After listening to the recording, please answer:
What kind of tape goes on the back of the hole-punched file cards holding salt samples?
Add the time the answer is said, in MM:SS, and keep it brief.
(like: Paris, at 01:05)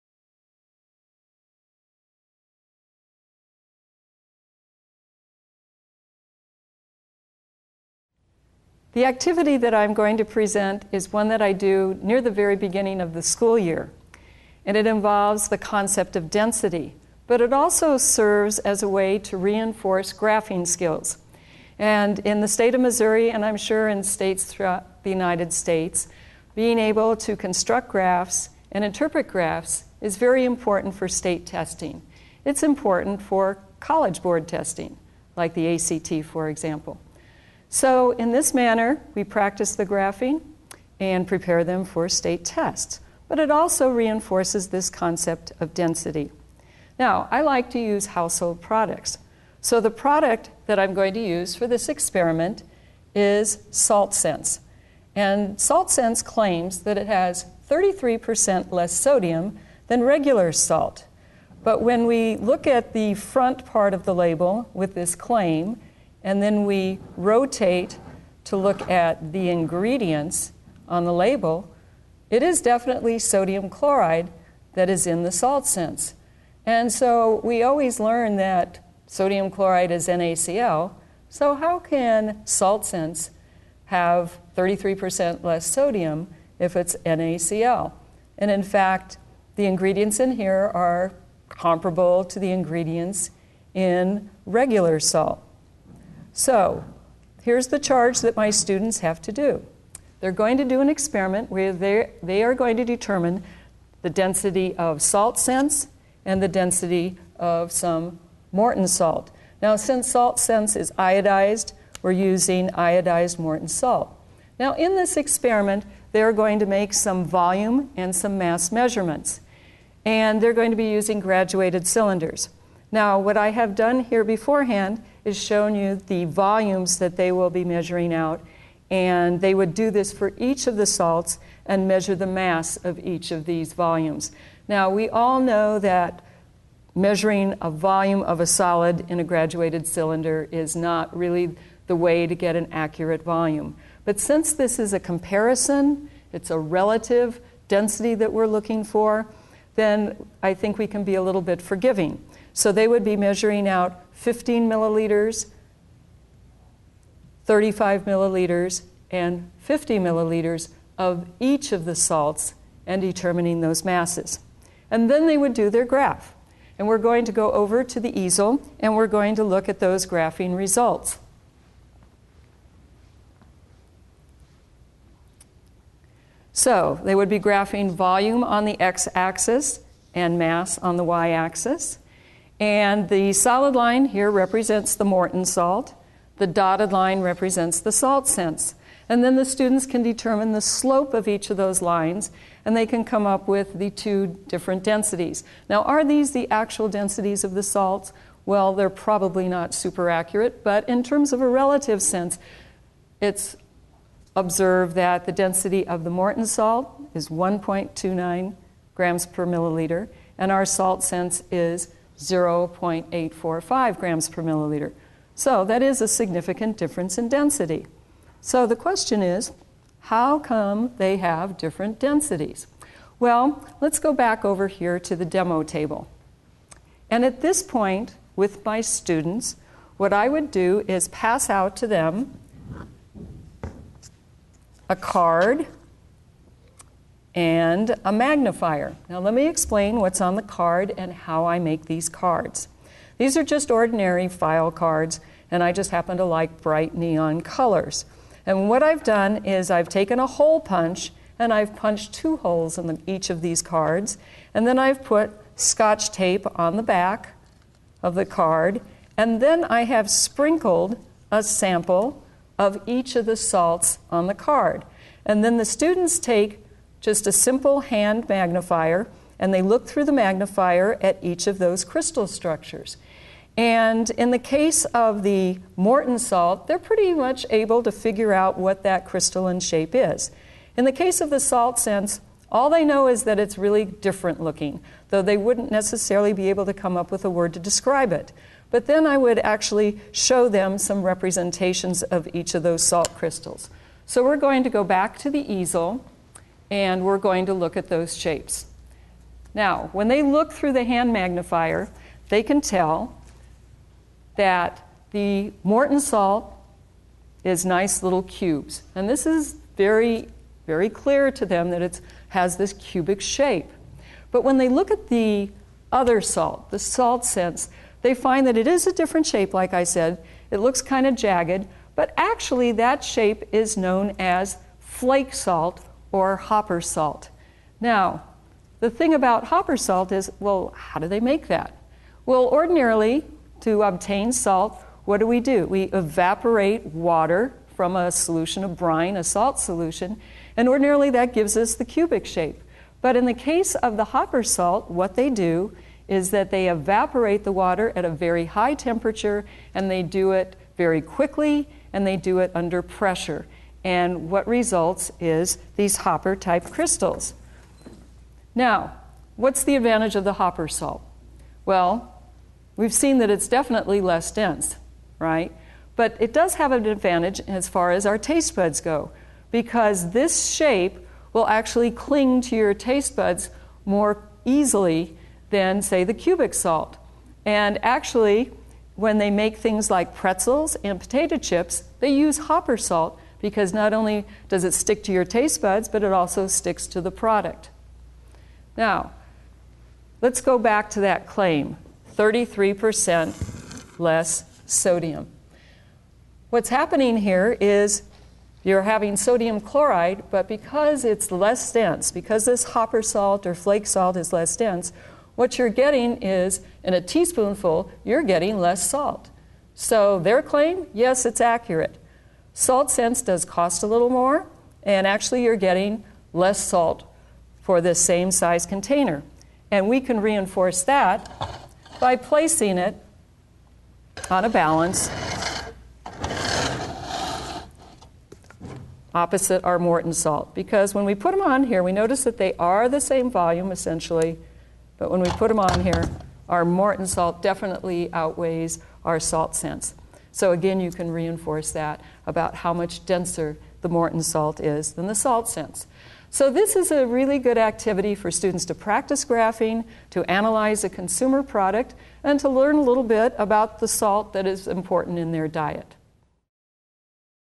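Scotch tape, at 04:15.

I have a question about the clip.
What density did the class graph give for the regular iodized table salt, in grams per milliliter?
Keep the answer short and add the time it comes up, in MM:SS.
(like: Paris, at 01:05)
1.29, at 03:27.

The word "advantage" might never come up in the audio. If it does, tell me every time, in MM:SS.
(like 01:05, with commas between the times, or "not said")
05:59, 06:06.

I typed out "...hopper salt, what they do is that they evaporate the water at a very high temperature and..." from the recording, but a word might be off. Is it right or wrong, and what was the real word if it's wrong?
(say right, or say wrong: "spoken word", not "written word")
right.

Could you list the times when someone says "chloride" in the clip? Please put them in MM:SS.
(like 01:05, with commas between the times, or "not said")
01:13, 01:19, 06:39.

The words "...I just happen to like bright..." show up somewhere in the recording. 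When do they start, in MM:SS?
04:05.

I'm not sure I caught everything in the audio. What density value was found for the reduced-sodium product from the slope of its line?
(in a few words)
0.845 grams per milliliter.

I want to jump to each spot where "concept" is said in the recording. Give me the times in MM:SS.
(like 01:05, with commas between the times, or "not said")
00:15, 00:44.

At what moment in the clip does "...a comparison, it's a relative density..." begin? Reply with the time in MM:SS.
02:24.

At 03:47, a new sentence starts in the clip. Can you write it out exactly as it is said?
And at this point, with my students, what I would do is pass out to them a card and a magnifier.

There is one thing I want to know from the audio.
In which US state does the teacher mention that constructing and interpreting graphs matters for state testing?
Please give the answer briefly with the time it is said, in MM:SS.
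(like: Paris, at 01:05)
Missouri, at 00:22.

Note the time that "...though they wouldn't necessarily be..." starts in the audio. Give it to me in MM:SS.
04:45.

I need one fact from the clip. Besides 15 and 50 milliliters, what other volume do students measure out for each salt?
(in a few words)
35 milliliters.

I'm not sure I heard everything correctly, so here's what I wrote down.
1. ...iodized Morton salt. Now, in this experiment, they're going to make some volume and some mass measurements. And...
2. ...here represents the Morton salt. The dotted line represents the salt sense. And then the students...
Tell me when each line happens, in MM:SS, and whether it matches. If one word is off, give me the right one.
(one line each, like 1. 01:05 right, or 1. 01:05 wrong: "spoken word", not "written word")
1. 01:52 right
2. 03:04 right.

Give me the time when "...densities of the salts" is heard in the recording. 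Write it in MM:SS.
03:16.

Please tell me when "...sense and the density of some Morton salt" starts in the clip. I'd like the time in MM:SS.
01:45.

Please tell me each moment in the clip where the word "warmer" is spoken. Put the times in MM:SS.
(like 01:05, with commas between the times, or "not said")
not said.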